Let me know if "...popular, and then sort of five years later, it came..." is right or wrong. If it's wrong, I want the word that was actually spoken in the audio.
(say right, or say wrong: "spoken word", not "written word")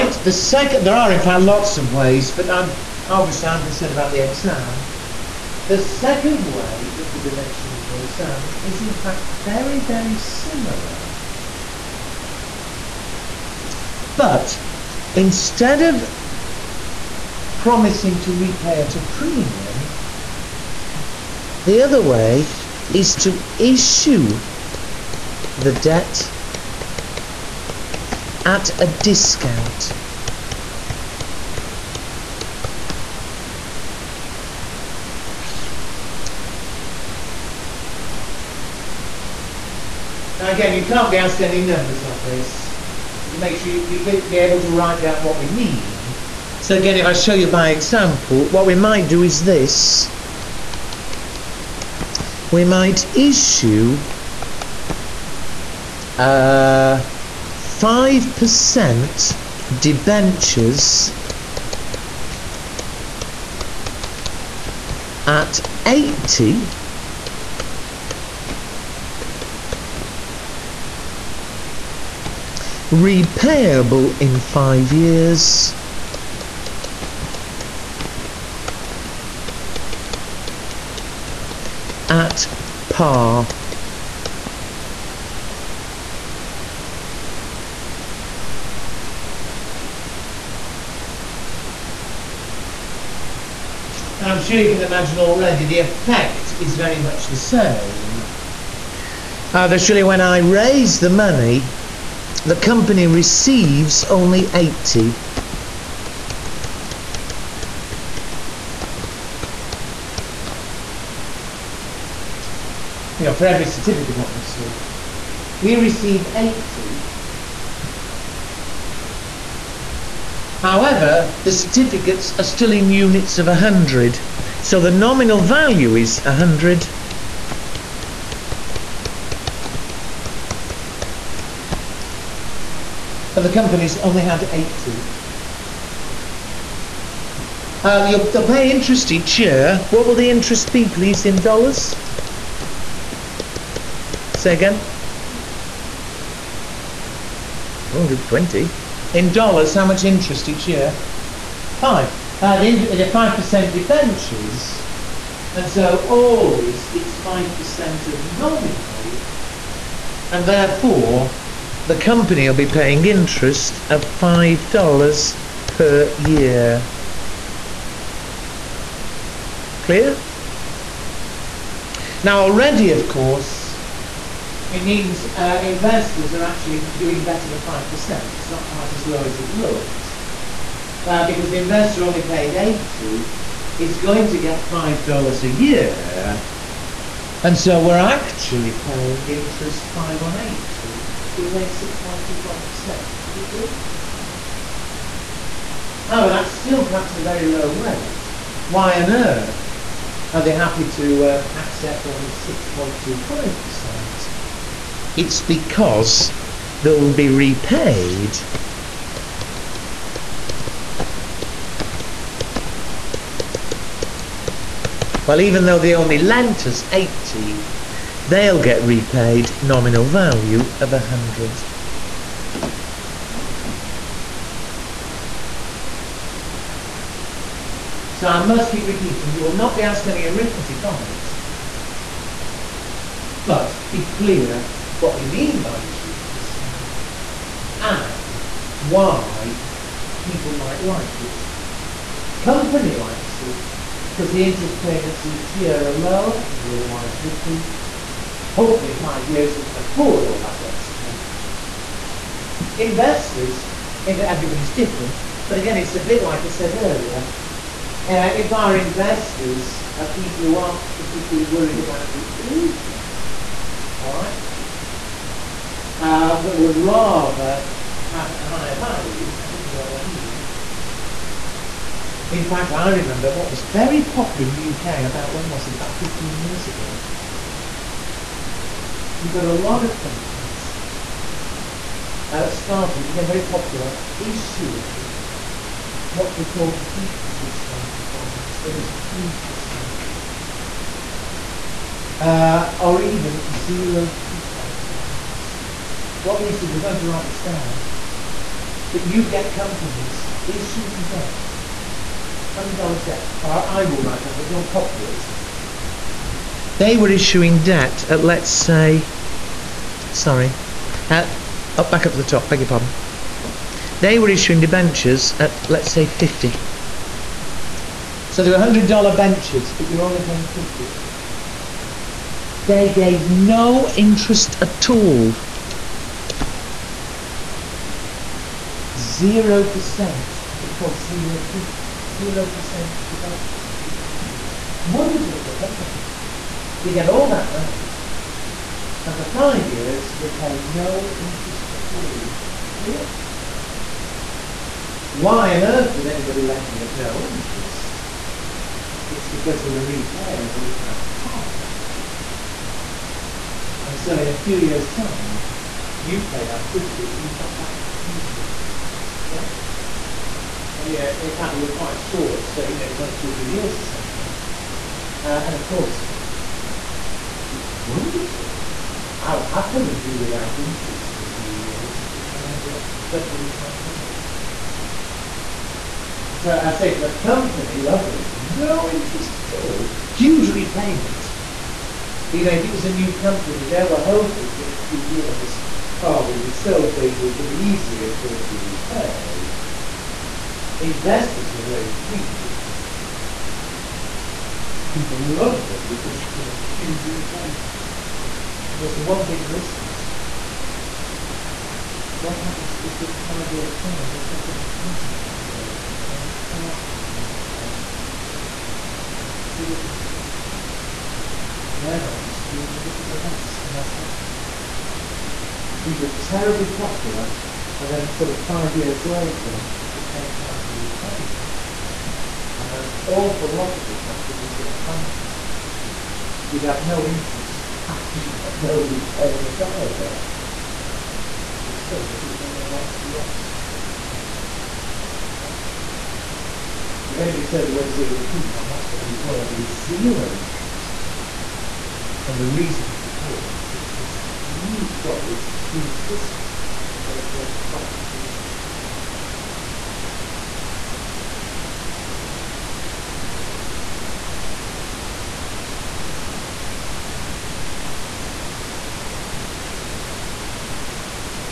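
right.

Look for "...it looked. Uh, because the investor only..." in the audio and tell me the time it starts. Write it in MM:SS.
02:59.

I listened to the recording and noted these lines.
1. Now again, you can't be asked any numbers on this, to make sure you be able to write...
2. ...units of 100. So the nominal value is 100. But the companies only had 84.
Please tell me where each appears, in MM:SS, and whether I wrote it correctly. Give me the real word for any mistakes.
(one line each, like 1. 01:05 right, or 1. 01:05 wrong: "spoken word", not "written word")
1. 00:40 right
2. 02:02 wrong: "80", not "84".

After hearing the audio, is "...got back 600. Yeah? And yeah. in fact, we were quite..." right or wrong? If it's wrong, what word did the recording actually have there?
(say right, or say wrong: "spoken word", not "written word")
wrong: "100", not "600".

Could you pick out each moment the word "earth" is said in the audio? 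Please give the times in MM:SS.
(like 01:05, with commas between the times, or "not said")
03:19, 05:45.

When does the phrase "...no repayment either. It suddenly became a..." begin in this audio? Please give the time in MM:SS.
07:08.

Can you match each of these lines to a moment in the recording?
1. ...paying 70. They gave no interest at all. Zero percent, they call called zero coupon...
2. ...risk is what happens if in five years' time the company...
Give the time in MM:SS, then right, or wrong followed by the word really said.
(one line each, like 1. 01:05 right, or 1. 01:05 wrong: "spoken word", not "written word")
1. 05:20 wrong: "50", not "70"
2. 06:39 right.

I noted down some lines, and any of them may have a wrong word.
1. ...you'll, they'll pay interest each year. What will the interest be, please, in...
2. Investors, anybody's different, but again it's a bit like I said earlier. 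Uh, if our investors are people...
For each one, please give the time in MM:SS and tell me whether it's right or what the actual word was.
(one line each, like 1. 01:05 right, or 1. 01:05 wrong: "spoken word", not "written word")
1. 02:18 right
2. 04:12 wrong: "everybody", not "anybody".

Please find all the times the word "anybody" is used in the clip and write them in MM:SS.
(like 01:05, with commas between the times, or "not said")
05:46, 07:17.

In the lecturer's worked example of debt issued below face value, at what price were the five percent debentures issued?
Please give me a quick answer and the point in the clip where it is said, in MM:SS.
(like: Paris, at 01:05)
80, at 00:57.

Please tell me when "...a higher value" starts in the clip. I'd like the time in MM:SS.
04:28.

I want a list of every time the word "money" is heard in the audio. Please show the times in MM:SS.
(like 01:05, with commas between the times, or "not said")
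01:41, 05:37, 06:13.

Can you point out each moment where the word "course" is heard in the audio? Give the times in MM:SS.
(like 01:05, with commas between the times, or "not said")
02:53, 06:05.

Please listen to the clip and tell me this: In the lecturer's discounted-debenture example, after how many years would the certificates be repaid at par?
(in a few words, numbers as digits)
5 years.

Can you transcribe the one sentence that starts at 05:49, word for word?
It's because they were repayable at par.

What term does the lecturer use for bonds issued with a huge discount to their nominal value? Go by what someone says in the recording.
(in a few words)
Deep discounted bonds.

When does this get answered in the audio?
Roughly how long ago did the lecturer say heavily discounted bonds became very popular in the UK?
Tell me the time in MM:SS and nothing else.
04:35.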